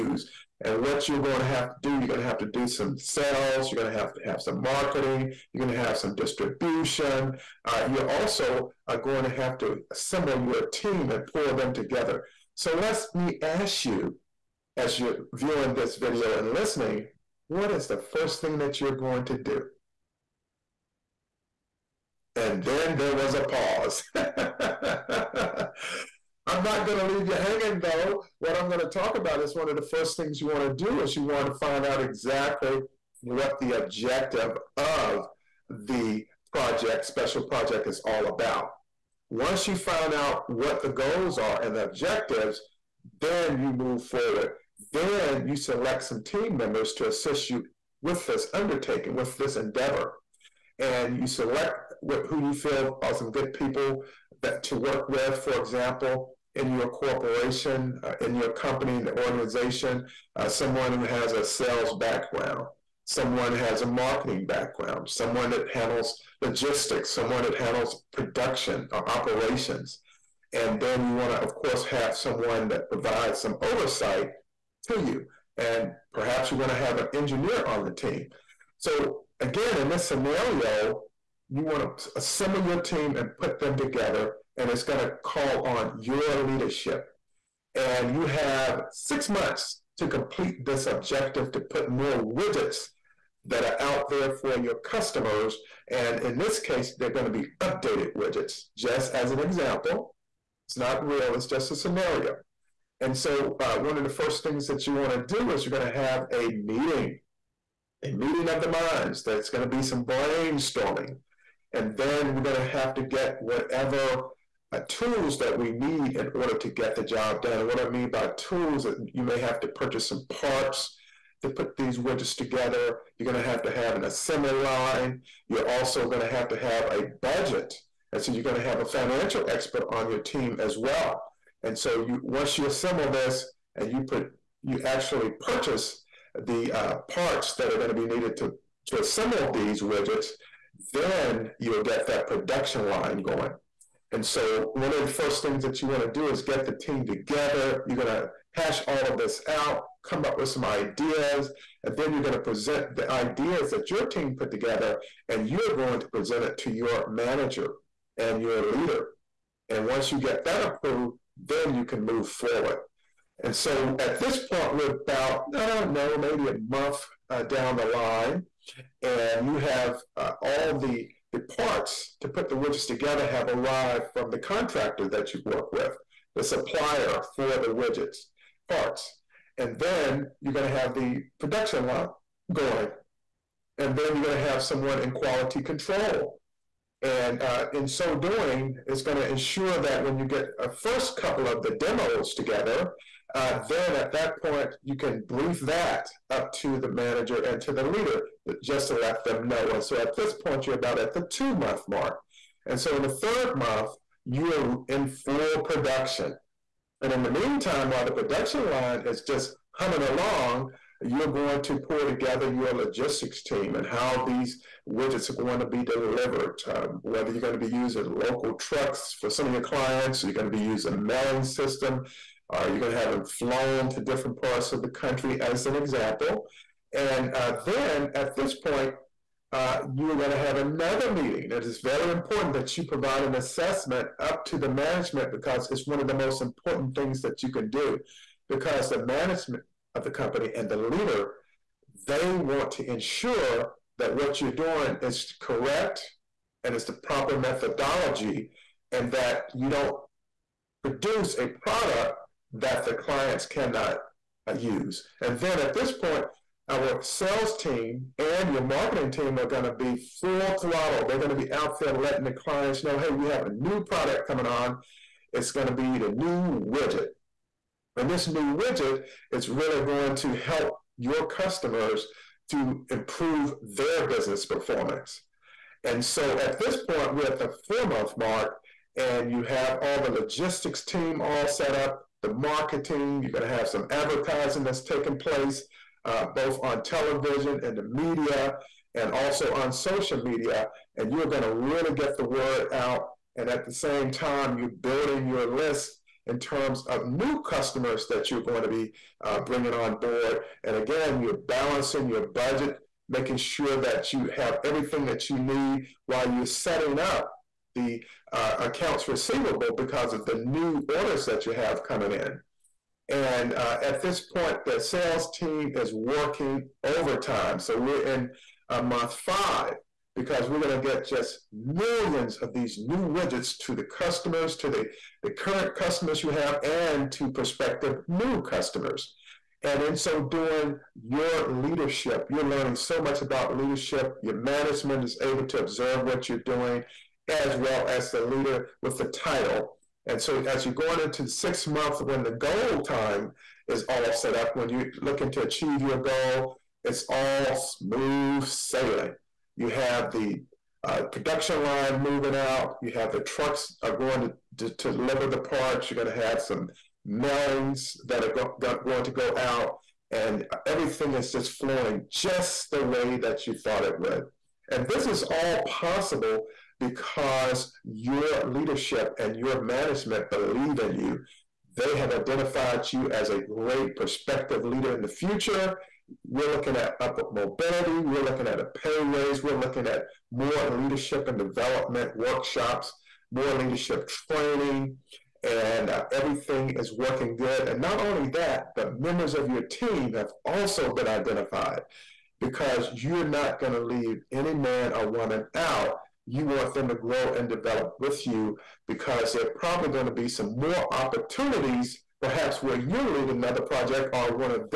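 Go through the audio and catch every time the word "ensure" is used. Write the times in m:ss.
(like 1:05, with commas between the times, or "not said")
3:09, 4:02.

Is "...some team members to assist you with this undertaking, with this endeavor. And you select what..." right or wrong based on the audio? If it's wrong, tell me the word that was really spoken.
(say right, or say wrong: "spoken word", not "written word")
right.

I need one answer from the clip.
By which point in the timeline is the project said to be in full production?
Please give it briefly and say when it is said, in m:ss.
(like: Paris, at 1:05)
Third month, at 3:23.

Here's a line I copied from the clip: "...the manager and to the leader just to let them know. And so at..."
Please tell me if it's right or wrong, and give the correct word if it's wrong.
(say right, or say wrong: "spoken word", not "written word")
right.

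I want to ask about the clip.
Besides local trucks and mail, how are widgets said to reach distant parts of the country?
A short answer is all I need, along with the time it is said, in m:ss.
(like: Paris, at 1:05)
Flown, at 3:43.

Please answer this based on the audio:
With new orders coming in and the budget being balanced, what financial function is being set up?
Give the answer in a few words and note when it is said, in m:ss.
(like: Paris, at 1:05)
Accounts receivable, at 5:08.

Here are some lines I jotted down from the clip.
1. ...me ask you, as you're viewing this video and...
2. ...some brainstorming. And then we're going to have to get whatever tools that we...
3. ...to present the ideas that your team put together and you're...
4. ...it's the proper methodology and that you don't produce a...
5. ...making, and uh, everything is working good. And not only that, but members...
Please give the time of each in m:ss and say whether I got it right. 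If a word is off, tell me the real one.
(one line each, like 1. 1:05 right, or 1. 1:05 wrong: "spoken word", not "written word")
1. 0:13 right
2. 1:49 right
3. 2:32 right
4. 4:06 right
5. 6:24 wrong: "training", not "making".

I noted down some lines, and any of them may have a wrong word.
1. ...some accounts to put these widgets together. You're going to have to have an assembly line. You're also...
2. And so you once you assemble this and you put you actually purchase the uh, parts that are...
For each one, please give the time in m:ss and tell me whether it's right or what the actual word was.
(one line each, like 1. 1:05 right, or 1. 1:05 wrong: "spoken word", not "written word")
1. 2:00 wrong: "parts", not "accounts"
2. 2:11 right.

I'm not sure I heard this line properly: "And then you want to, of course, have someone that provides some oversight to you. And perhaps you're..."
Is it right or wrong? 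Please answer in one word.
right.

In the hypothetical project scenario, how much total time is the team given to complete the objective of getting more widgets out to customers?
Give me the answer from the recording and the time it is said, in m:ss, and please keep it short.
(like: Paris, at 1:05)
6 months, at 1:28.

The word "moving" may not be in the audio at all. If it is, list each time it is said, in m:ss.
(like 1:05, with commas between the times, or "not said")
5:52.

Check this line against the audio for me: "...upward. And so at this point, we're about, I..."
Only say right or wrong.
wrong.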